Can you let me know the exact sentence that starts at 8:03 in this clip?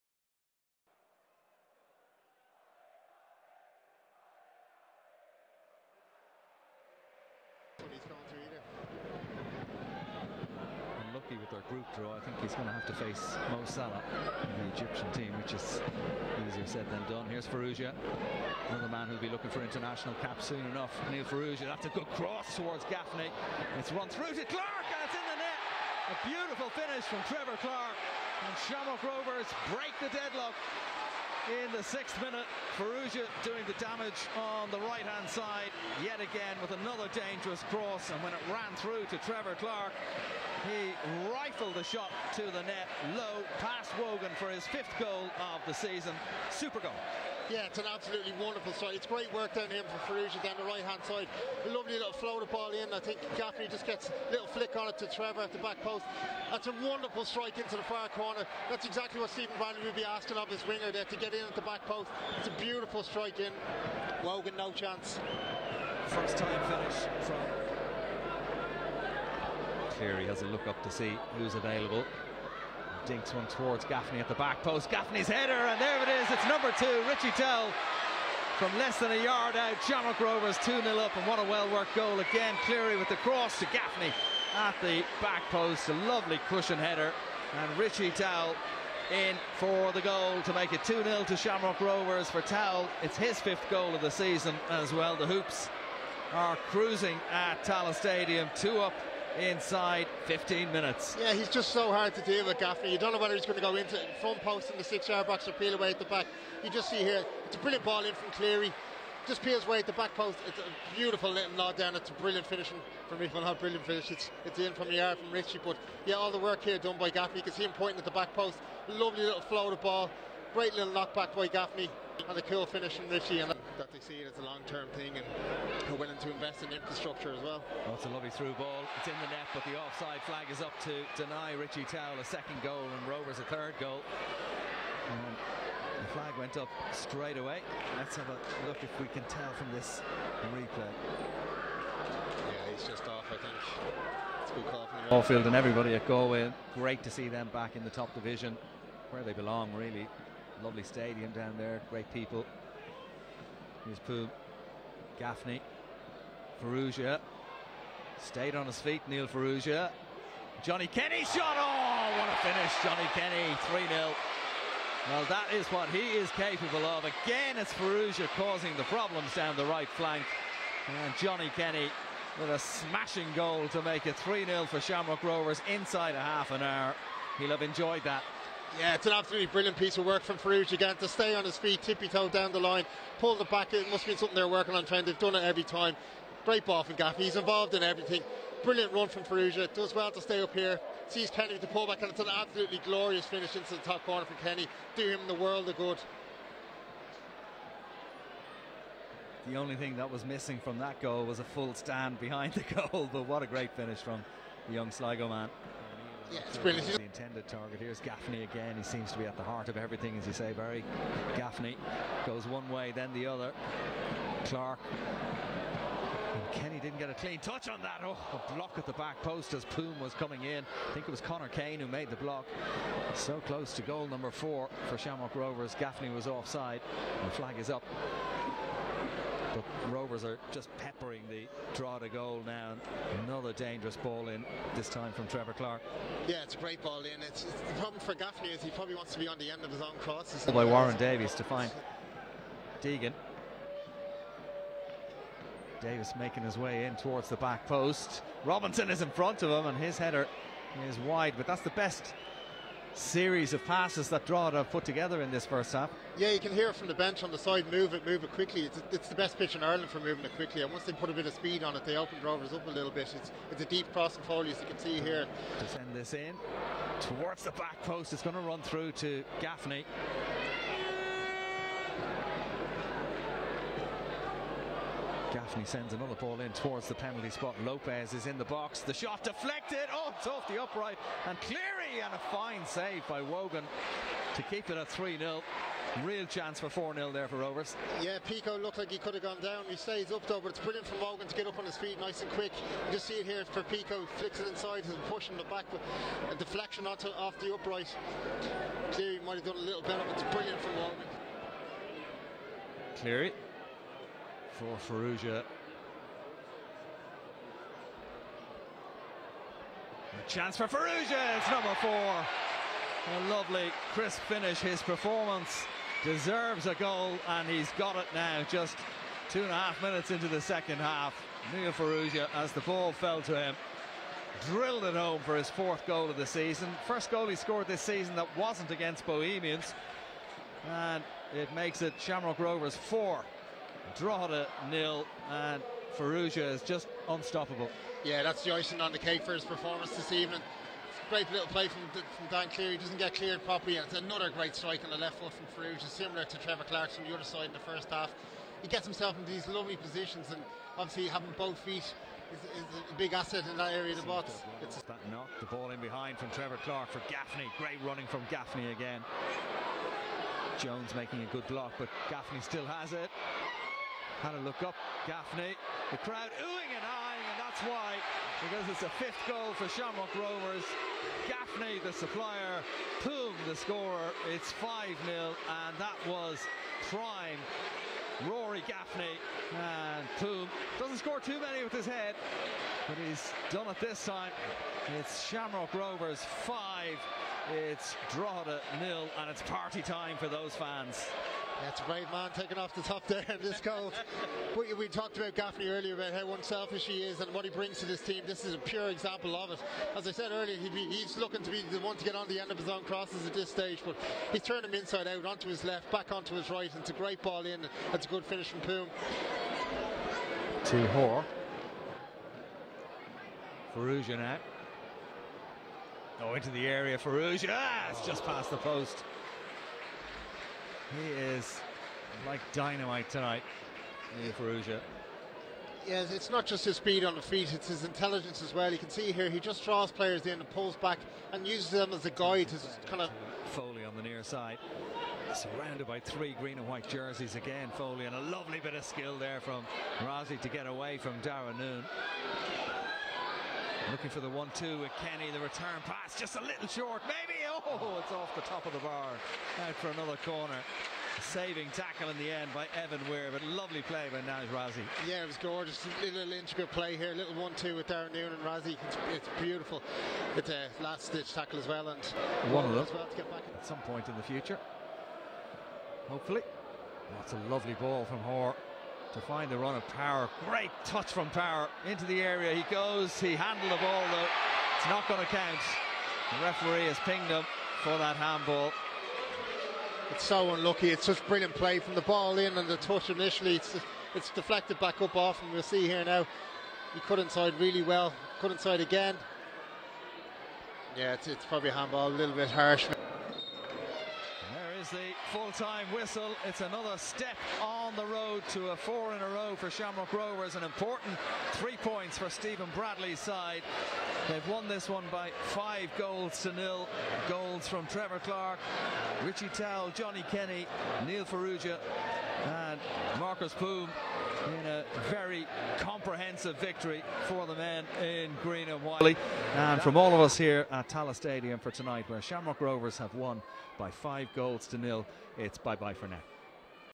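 It's, it's deflected back up off, and we'll see here now.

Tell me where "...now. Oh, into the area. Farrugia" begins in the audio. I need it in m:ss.
6:54.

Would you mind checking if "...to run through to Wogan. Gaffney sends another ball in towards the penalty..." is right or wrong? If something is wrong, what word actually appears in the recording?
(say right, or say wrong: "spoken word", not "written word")
wrong: "Gaffney", not "Wogan".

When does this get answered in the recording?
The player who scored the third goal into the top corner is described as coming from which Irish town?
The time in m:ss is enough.
3:24.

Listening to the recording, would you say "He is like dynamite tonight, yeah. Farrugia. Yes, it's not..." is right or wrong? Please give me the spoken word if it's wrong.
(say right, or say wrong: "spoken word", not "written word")
right.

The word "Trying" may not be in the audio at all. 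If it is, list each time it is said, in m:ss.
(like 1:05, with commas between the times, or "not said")
3:04.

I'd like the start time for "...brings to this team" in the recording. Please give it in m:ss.
6:37.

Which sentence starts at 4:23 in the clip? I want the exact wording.
It's, it's a deep crossing for you, as you can see here.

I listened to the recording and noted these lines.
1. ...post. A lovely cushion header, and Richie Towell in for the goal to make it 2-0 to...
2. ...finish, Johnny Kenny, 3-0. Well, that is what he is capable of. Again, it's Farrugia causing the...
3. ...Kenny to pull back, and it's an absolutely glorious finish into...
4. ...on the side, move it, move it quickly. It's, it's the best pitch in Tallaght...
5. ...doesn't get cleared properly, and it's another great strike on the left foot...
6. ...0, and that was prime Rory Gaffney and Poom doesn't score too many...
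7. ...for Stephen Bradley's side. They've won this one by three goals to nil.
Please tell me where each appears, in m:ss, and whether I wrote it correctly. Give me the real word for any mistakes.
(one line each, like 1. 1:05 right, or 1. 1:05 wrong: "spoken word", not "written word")
1. 1:25 right
2. 2:42 right
3. 3:11 right
4. 4:17 wrong: "Ireland", not "Tallaght"
5. 5:42 right
6. 6:15 right
7. 8:22 wrong: "five", not "three".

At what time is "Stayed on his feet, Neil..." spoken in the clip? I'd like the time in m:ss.
2:38.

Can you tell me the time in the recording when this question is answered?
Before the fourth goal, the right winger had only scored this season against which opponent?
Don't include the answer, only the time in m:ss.
5:29.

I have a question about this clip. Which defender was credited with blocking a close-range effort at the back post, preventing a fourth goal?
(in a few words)
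Connor Kane.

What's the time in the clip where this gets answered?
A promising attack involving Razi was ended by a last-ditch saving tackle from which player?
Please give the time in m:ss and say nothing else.
7:32.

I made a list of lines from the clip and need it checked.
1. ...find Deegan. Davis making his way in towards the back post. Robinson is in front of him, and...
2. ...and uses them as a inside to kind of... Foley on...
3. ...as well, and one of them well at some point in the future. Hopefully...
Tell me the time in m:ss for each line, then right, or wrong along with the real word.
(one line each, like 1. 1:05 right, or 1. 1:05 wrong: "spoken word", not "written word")
1. 4:01 right
2. 7:11 wrong: "guide", not "inside"
3. 7:41 right.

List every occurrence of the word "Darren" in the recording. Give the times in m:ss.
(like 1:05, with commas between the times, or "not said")
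7:21, 7:37.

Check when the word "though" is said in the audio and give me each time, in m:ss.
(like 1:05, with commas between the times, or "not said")
4:50, 7:54.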